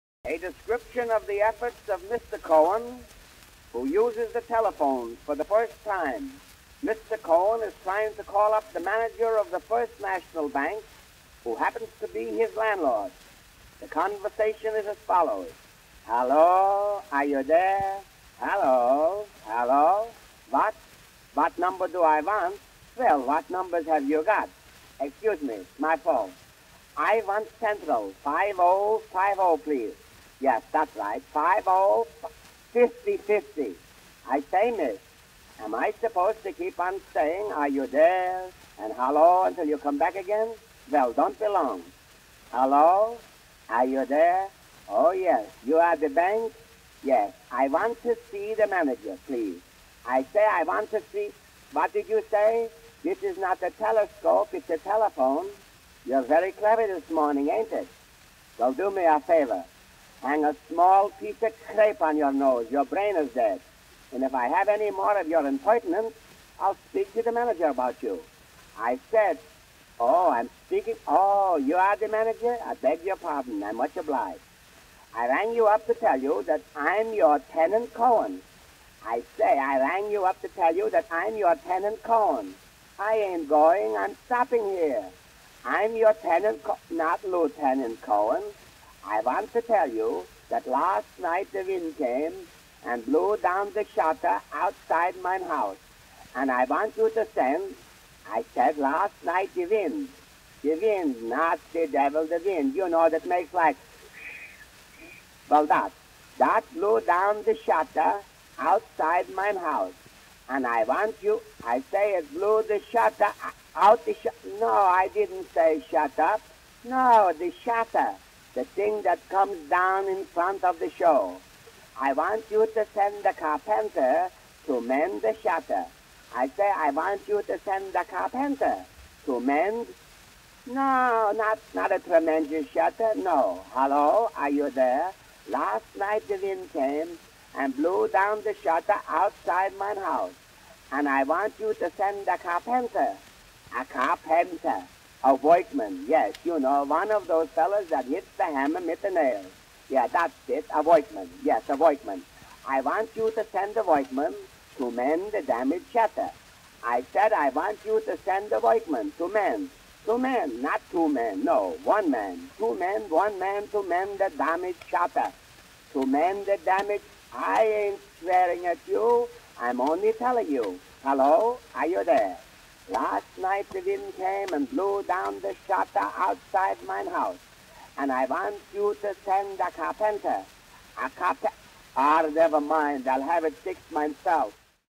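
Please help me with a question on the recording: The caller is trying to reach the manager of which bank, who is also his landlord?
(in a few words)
First National Bank.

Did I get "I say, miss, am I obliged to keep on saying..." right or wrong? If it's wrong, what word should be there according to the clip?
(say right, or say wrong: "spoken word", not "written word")
wrong: "supposed", not "obliged".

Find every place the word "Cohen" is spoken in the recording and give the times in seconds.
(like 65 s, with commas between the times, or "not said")
2 s, 7 s, 77 s, 82 s, 88 s.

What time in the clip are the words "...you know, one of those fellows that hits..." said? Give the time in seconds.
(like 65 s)
146 s.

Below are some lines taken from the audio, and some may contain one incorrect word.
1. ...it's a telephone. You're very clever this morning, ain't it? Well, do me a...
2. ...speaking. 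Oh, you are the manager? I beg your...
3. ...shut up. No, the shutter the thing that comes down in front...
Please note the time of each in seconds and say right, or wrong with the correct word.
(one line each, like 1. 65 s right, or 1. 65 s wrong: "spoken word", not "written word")
1. 54 s right
2. 70 s right
3. 115 s right.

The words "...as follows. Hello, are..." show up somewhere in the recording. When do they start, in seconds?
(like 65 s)
14 s.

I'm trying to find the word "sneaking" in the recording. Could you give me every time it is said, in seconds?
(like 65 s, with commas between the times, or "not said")
not said.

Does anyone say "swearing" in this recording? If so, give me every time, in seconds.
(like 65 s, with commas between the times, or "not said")
168 s.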